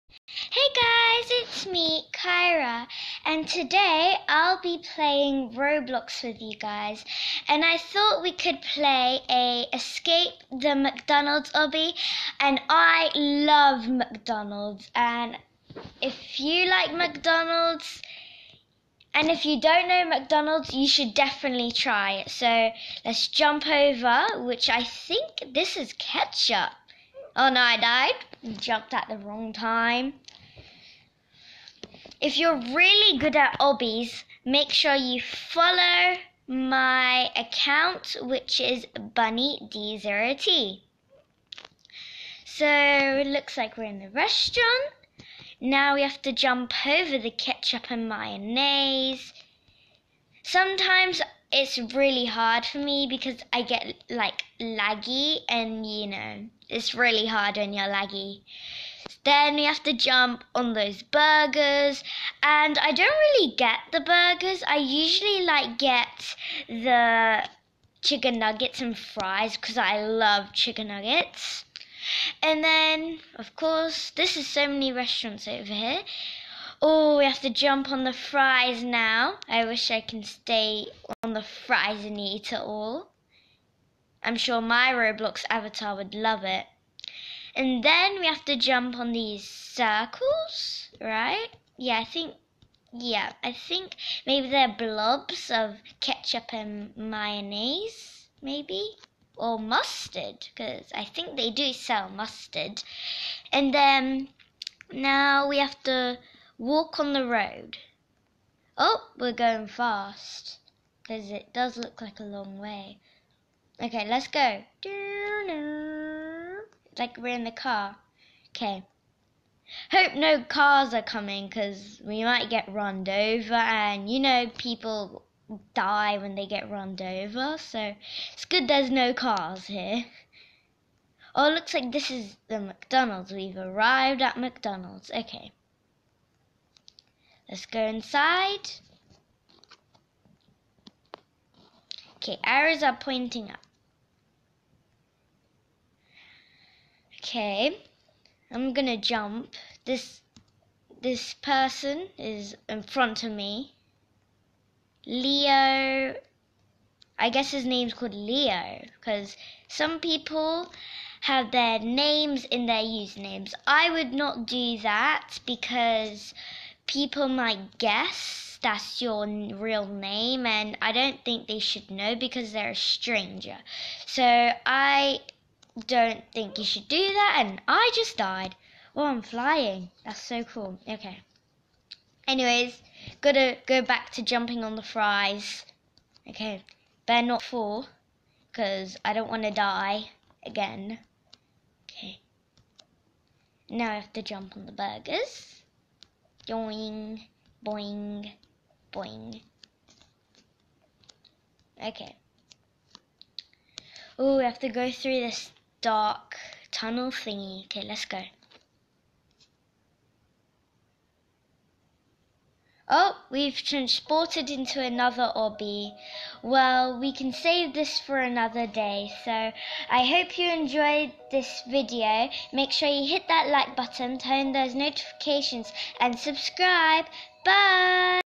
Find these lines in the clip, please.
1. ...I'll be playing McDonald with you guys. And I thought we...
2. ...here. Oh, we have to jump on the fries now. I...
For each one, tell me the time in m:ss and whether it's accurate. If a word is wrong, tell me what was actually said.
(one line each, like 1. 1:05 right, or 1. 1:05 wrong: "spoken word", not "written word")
1. 0:04 wrong: "Roblox", not "McDonald"
2. 1:15 right.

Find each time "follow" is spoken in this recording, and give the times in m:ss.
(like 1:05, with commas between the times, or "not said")
0:35.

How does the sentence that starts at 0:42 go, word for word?
So it looks like we're in the restaurant.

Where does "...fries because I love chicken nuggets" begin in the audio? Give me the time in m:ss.
1:08.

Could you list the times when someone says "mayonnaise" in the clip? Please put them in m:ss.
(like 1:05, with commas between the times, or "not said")
0:48, 1:36.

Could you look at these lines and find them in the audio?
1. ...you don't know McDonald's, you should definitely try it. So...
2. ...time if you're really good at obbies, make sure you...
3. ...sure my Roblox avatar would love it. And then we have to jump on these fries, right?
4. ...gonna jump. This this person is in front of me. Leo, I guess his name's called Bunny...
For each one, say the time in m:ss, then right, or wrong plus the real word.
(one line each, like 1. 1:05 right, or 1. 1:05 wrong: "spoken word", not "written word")
1. 0:19 right
2. 0:29 right
3. 1:24 wrong: "circles", not "fries"
4. 2:28 wrong: "Leo", not "Bunny".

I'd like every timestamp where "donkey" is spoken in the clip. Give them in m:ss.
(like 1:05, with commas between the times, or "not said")
not said.